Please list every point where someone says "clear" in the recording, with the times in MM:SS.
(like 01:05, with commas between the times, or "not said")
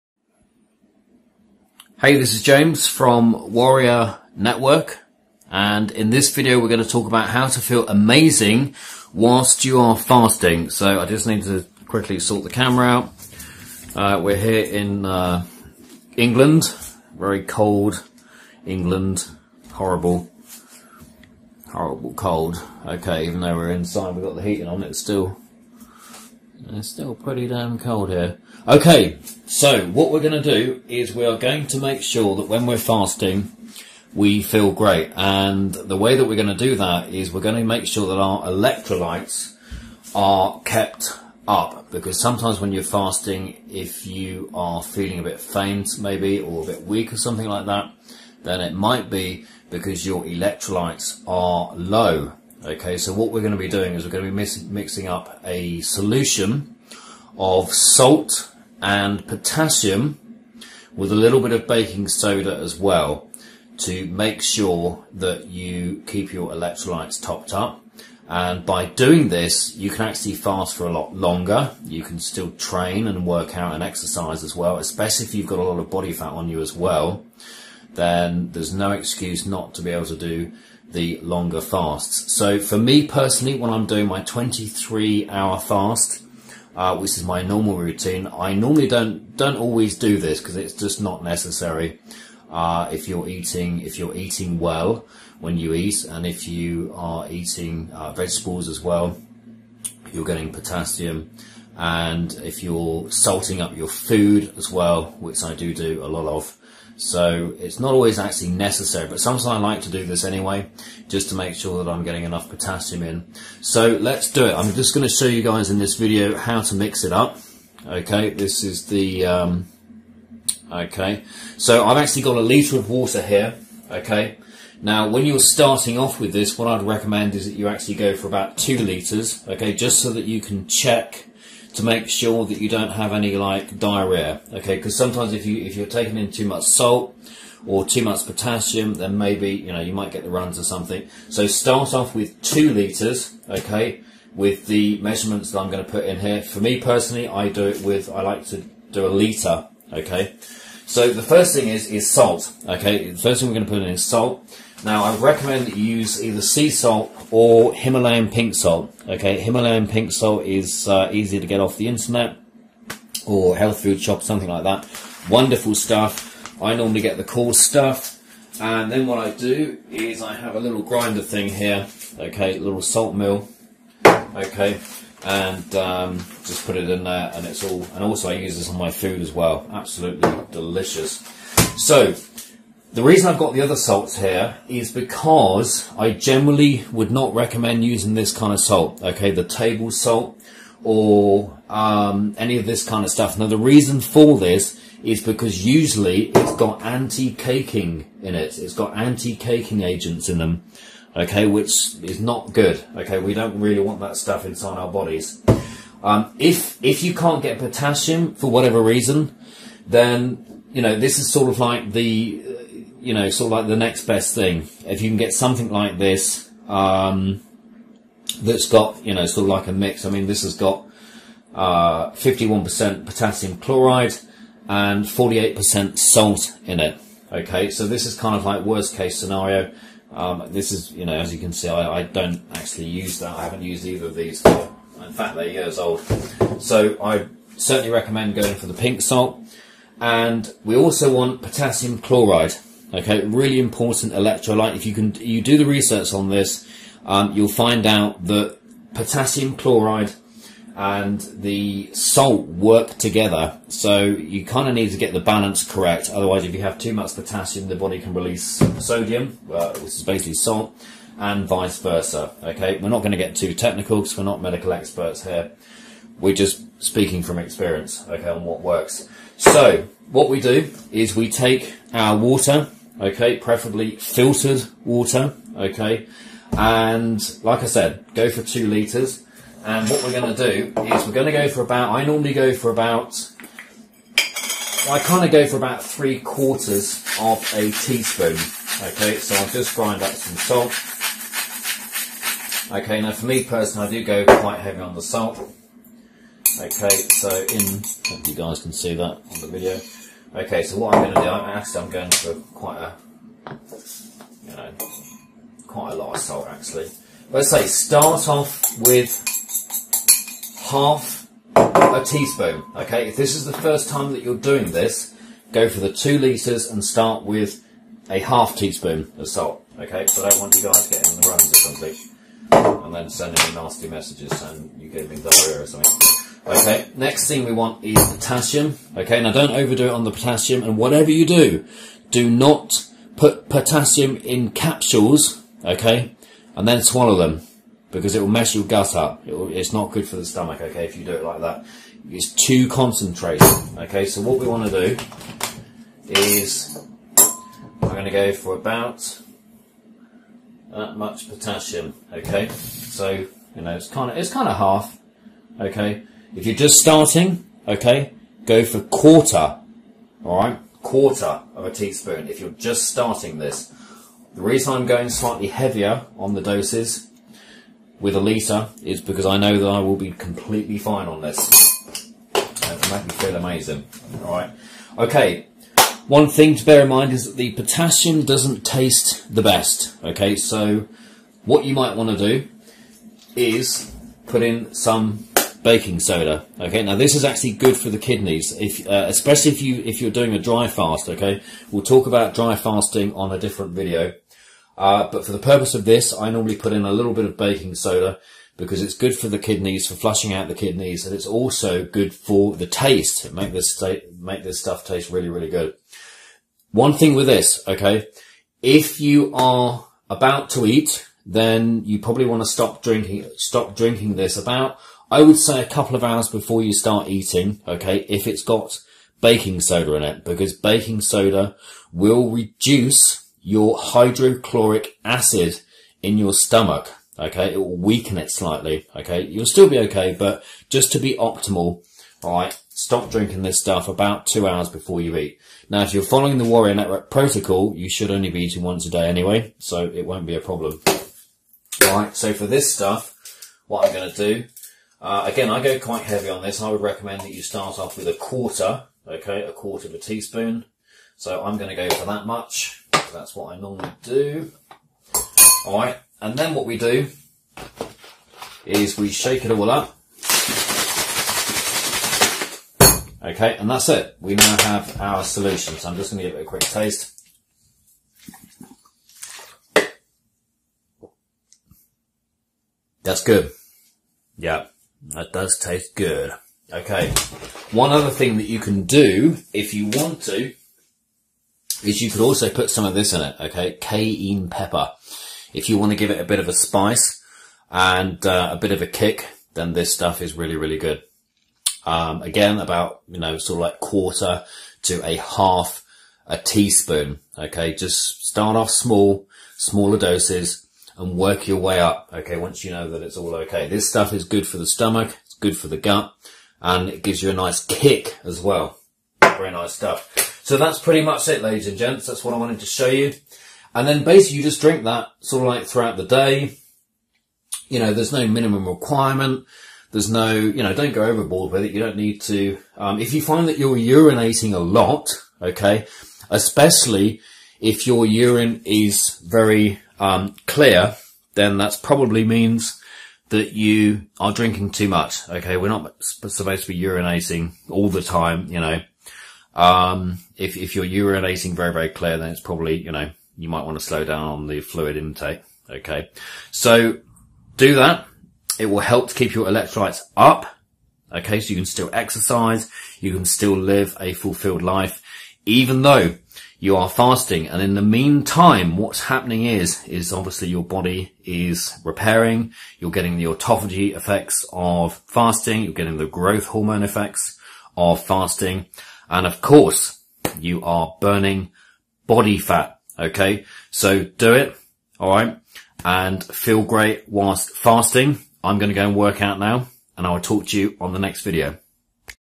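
08:50, 09:01.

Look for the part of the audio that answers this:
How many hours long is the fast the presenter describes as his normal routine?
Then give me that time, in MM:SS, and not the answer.
01:24.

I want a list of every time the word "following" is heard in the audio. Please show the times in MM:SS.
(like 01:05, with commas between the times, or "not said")
07:16.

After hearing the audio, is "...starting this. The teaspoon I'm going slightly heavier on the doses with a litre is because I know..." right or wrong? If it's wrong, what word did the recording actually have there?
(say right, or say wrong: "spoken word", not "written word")
wrong: "reason", not "teaspoon".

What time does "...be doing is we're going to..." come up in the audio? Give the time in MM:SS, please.
00:53.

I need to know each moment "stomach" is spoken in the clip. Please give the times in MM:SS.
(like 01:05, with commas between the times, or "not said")
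05:40, 07:06, 08:24.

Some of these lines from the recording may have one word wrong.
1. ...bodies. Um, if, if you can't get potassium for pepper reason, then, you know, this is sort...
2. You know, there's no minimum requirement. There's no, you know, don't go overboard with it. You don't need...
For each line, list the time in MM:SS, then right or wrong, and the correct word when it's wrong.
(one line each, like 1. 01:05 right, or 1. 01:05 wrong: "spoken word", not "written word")
1. 03:24 wrong: "whatever", not "pepper"
2. 08:37 right.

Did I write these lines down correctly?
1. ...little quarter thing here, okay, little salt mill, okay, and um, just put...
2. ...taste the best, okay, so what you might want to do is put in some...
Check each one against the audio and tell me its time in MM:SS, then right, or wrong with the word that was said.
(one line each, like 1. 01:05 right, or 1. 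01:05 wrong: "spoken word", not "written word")
1. 02:50 wrong: "grinder", not "quarter"
2. 06:18 right.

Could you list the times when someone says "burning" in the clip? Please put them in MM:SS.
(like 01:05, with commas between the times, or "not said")
09:31.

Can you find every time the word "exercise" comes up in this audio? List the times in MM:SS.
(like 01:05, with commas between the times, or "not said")
01:13, 09:11.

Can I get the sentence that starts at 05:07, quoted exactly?
Let's say start off with half a teaspoon.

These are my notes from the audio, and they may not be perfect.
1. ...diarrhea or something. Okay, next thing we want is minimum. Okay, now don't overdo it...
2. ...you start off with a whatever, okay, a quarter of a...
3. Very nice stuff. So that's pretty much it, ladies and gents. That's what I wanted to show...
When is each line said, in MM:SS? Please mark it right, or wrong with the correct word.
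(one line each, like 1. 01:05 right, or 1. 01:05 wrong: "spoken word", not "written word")
1. 05:25 wrong: "potassium", not "minimum"
2. 07:27 wrong: "quarter", not "whatever"
3. 08:29 right.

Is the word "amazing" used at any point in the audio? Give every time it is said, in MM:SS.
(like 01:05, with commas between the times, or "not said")
00:07, 06:13.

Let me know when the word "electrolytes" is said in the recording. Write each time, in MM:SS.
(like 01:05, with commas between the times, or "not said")
00:38, 00:50, 01:06, 04:04, 09:09.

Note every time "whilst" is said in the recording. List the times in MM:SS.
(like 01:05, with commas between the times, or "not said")
00:09, 09:37.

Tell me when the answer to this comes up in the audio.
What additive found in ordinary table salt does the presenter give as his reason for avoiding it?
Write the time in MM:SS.
03:18.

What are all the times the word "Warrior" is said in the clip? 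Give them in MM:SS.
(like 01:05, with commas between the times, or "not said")
00:03, 07:16.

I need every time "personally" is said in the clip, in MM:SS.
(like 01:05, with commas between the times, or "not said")
01:23, 02:26, 04:53.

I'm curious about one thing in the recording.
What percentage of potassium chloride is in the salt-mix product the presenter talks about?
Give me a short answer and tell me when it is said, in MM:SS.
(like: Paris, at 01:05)
51%, at 03:42.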